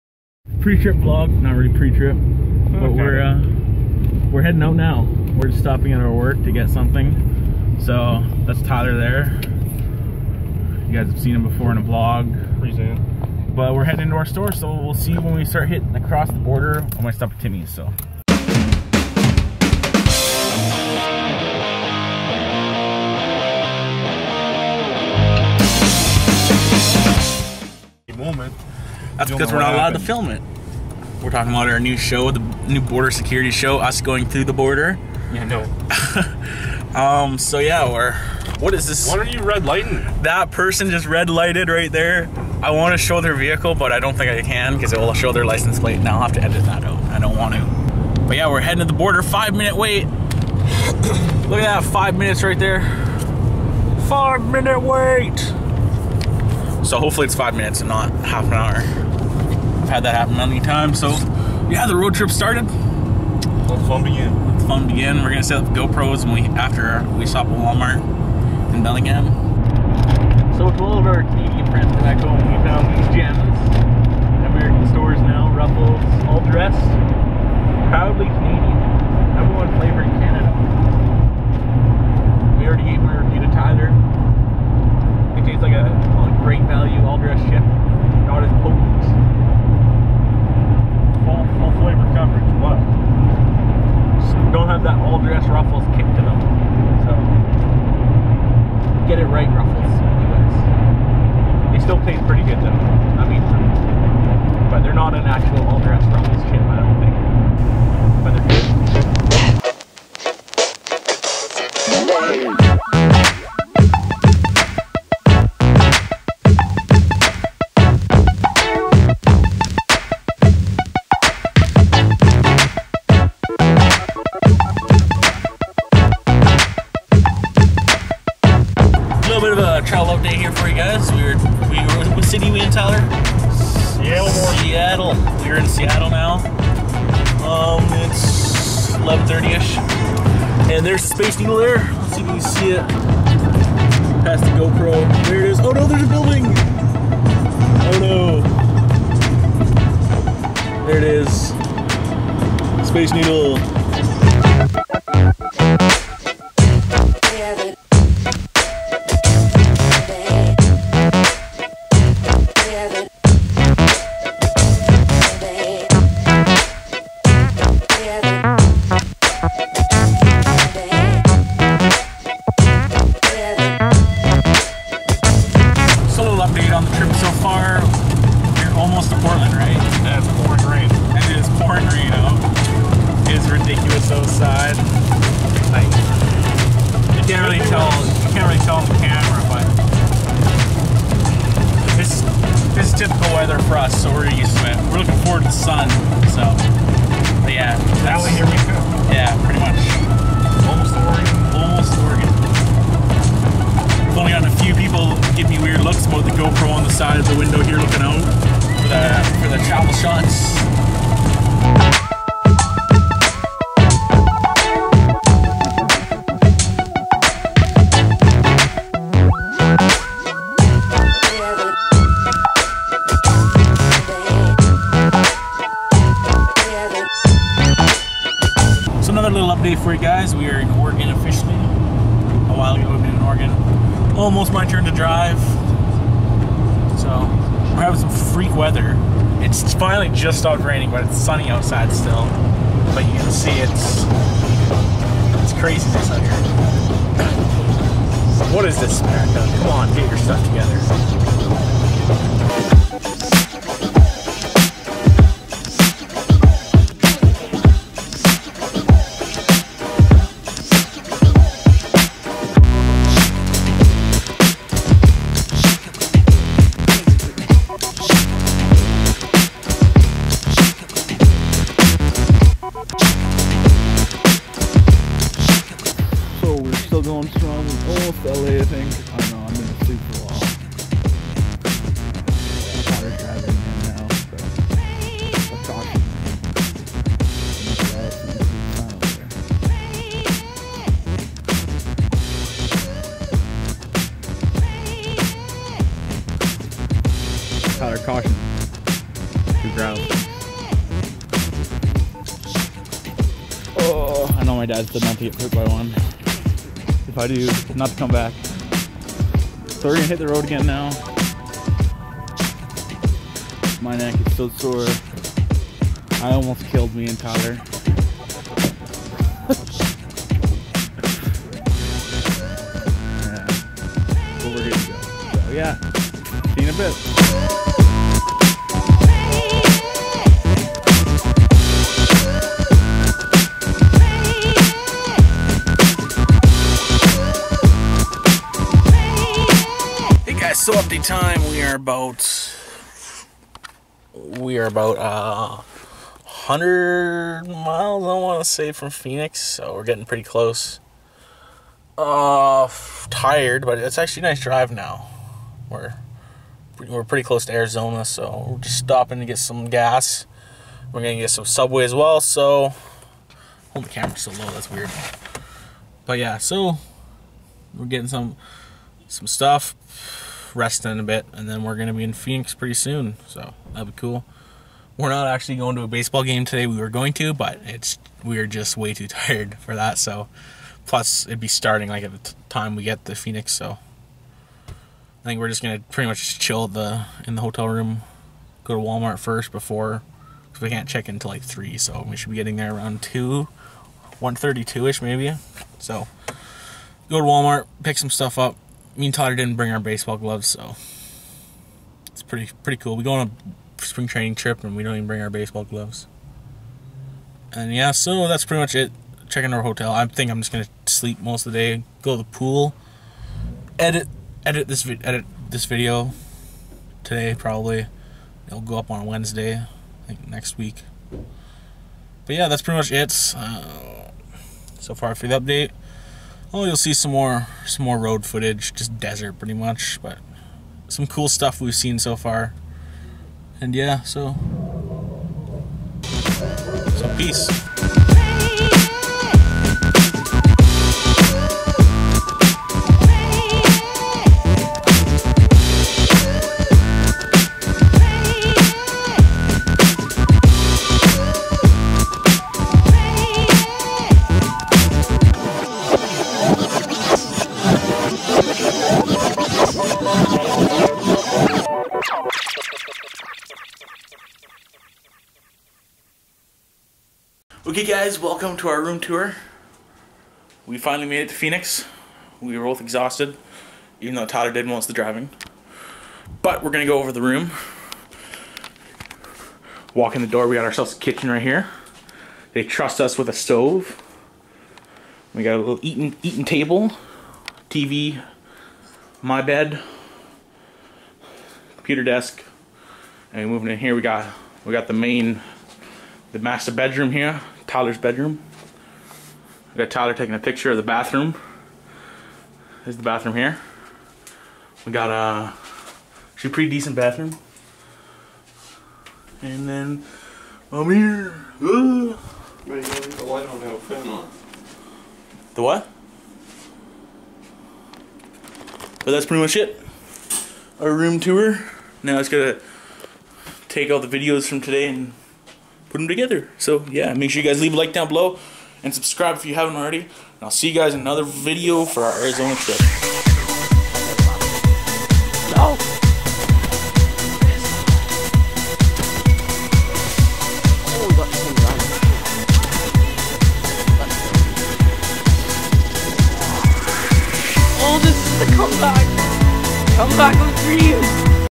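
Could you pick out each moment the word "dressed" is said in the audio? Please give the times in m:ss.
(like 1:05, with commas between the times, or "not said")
1:16, 1:27.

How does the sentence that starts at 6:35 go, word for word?
So go to Walmart, pick some stuff up, me and Todd didn't bring our baseball gloves, so it's pretty pretty cool.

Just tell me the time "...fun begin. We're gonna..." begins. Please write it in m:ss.
1:04.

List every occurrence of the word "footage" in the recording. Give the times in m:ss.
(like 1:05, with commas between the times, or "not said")
7:08.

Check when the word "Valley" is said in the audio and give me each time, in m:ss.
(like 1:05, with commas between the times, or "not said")
3:18.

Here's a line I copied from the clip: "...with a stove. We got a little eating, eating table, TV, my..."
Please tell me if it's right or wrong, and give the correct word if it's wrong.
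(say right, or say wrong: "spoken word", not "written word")
right.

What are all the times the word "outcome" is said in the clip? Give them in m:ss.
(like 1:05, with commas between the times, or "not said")
not said.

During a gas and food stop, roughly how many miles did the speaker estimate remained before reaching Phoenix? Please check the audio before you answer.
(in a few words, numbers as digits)
100 miles.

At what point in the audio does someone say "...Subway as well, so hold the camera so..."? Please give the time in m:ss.
6:01.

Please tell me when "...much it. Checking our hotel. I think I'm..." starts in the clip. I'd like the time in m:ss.
6:48.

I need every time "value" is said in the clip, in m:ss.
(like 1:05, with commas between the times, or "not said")
1:26.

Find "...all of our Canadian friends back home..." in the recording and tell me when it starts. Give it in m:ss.
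1:10.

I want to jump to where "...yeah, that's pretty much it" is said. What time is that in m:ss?
7:02.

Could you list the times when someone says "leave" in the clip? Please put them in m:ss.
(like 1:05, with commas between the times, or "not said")
8:32, 8:47.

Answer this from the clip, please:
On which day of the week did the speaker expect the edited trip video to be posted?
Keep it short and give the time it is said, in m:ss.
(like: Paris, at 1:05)
Wednesday, at 6:59.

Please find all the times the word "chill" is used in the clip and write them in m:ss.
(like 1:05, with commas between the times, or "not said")
6:26.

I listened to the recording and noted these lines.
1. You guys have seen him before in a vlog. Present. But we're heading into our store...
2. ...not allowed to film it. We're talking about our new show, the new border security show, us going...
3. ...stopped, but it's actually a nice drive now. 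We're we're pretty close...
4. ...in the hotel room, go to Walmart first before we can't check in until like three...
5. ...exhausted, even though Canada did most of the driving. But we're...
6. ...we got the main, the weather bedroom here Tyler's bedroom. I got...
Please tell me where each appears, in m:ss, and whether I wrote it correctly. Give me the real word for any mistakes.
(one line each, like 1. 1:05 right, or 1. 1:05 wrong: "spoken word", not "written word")
1. 0:10 right
2. 0:29 right
3. 5:53 wrong: "tired", not "stopped"
4. 6:27 right
5. 7:52 wrong: "Tyler", not "Canada"
6. 8:14 wrong: "master", not "weather".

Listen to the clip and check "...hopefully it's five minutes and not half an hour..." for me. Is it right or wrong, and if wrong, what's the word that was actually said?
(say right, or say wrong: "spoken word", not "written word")
right.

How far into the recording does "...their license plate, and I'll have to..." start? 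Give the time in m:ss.
0:45.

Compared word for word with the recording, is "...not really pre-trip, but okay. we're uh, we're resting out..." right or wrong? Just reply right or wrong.
wrong.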